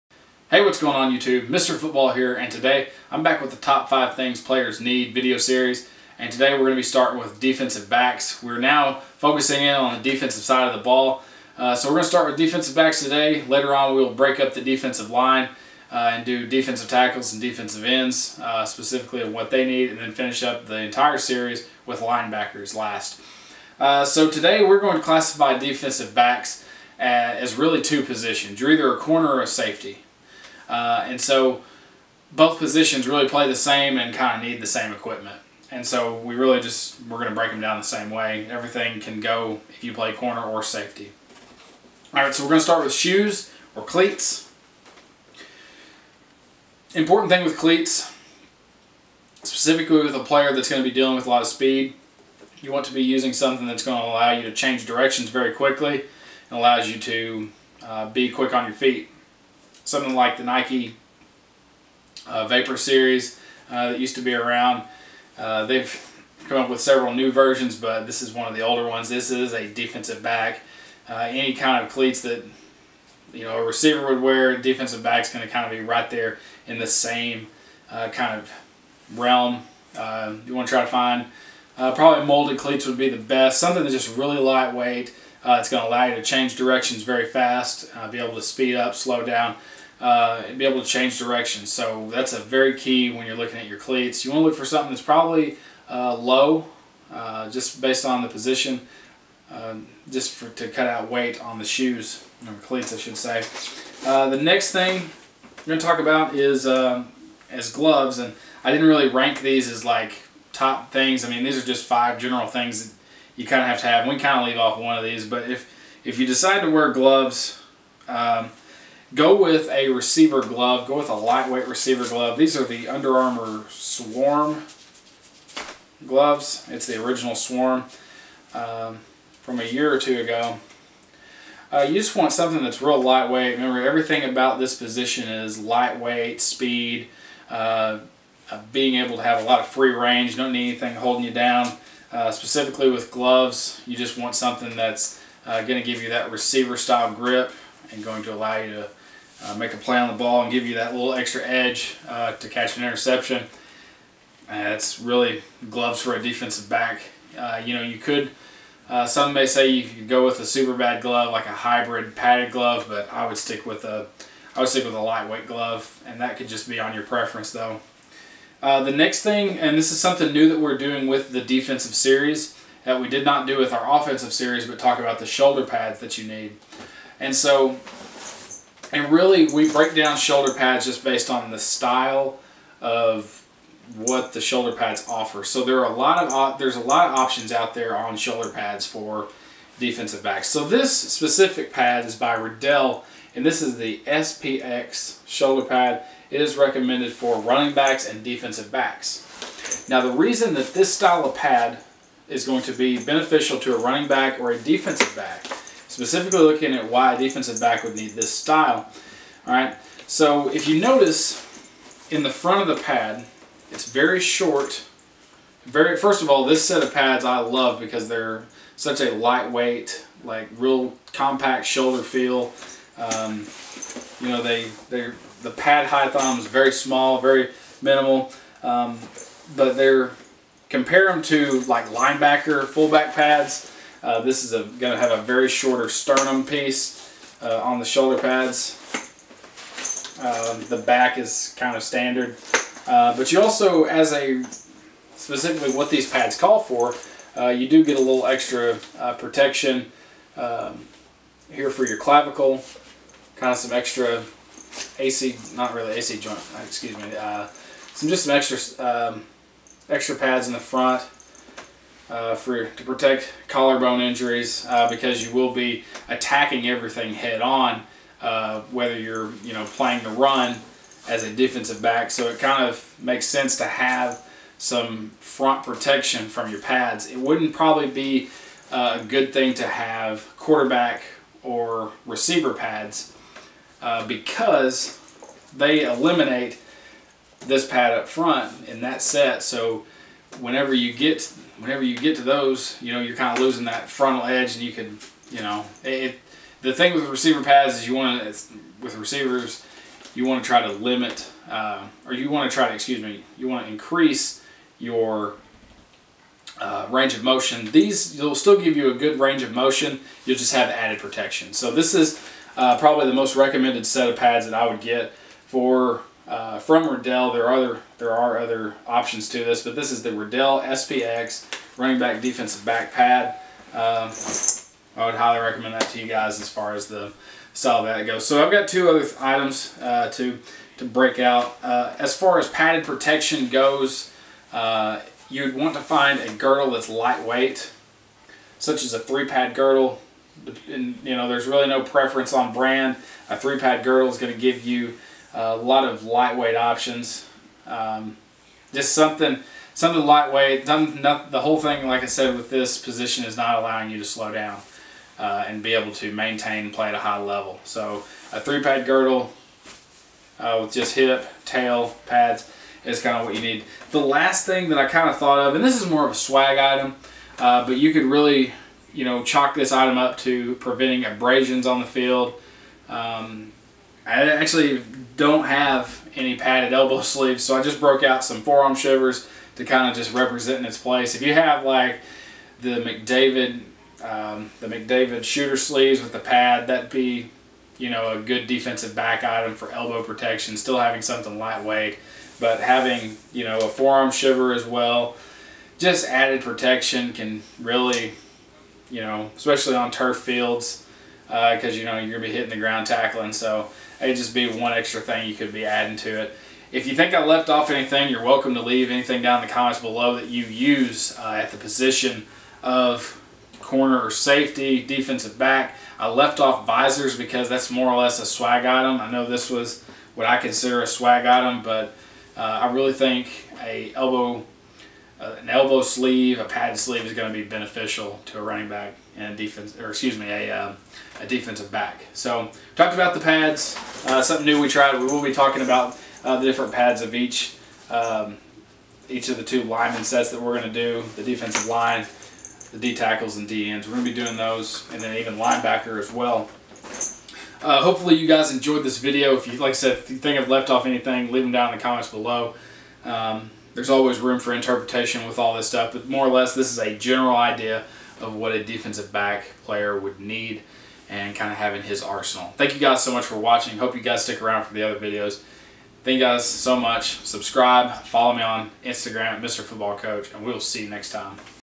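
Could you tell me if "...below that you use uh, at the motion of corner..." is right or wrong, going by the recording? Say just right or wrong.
wrong.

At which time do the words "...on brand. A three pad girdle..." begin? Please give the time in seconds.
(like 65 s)
342 s.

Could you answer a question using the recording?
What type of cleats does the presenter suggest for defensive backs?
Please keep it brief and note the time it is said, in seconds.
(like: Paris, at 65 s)
Molded cleats, at 82 s.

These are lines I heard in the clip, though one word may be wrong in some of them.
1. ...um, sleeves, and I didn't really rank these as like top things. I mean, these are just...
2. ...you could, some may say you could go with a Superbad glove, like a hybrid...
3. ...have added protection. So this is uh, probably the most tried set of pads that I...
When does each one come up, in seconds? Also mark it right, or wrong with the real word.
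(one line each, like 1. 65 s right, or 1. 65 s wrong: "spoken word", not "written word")
1. 106 s wrong: "gloves", not "sleeves"
2. 157 s right
3. 310 s wrong: "recommended", not "tried".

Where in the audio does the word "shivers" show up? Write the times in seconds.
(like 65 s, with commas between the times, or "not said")
378 s, 394 s.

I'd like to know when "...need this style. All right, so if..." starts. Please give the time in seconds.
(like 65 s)
207 s.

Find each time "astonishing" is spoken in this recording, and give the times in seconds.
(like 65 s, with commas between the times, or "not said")
not said.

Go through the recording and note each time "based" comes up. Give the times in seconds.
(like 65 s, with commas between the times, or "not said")
97 s, 181 s.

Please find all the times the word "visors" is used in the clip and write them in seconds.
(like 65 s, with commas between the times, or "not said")
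416 s.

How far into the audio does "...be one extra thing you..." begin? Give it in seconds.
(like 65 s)
404 s.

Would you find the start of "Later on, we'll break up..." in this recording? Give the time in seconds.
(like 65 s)
13 s.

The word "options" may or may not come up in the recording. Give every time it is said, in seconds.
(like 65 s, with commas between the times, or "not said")
187 s, 318 s, 346 s.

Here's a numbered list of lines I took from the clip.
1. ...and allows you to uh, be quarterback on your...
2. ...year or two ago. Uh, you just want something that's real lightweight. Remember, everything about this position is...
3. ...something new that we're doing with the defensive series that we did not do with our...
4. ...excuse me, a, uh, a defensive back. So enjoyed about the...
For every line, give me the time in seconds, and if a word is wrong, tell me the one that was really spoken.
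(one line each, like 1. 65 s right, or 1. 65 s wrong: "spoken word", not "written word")
1. 56 s wrong: "quick", not "quarterback"
2. 129 s right
3. 169 s right
4. 429 s wrong: "talked", not "enjoyed".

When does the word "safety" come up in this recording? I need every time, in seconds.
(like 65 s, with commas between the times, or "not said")
29 s, 40 s, 414 s.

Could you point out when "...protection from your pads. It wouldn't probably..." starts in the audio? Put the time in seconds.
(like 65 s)
275 s.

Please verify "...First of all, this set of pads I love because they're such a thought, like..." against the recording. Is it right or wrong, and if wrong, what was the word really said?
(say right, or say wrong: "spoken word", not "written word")
wrong: "lightweight", not "thought".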